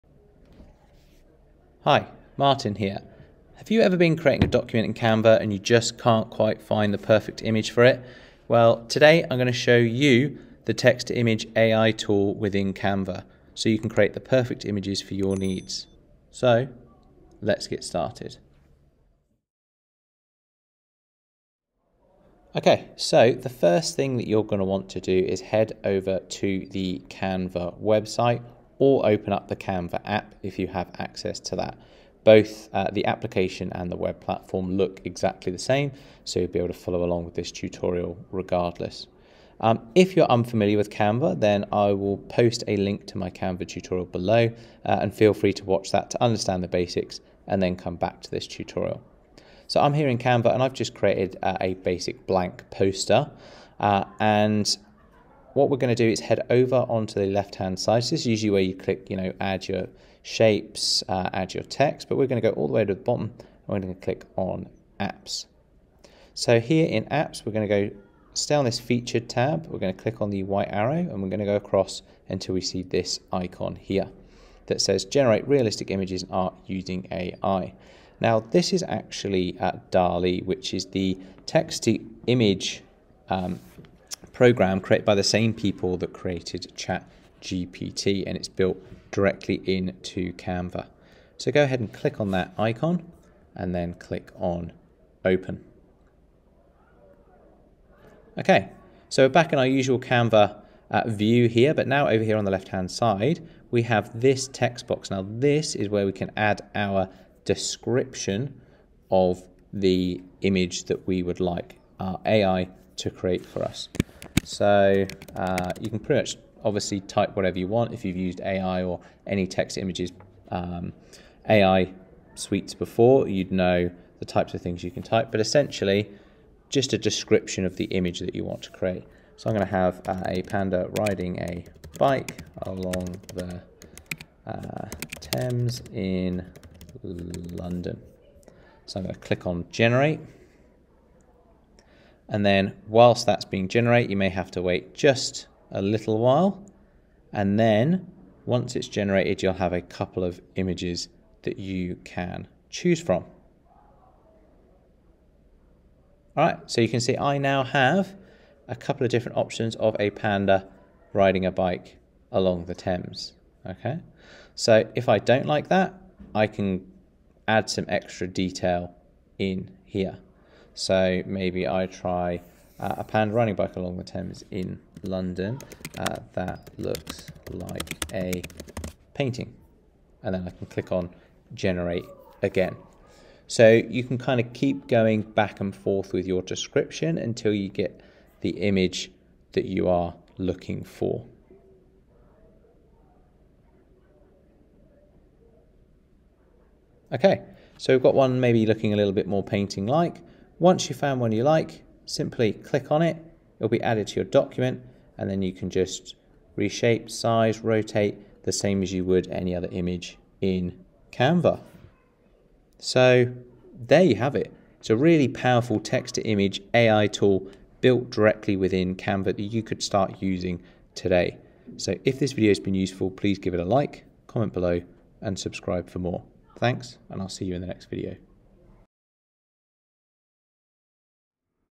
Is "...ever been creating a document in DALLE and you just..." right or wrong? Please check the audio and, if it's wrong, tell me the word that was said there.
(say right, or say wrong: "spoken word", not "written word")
wrong: "Canva", not "DALLE".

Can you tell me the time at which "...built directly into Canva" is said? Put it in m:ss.
1:28.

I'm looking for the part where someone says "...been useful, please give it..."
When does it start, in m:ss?
3:42.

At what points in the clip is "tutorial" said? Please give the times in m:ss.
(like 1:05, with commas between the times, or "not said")
0:37, 0:43, 0:48.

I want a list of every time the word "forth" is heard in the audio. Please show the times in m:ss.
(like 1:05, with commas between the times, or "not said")
3:05.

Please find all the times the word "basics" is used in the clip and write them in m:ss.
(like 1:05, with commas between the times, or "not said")
0:46, 0:51.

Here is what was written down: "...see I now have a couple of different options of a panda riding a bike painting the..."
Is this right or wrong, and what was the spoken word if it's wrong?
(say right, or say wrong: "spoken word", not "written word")
wrong: "along", not "painting".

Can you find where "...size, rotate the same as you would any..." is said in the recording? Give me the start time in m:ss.
3:27.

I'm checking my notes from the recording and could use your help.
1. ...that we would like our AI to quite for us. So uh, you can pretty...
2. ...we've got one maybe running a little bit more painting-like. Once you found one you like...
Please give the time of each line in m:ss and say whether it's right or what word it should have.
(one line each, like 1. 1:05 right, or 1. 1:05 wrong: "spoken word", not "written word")
1. 1:50 wrong: "create", not "quite"
2. 3:17 wrong: "looking", not "running".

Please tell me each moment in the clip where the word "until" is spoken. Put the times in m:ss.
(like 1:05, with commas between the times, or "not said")
1:12, 3:07.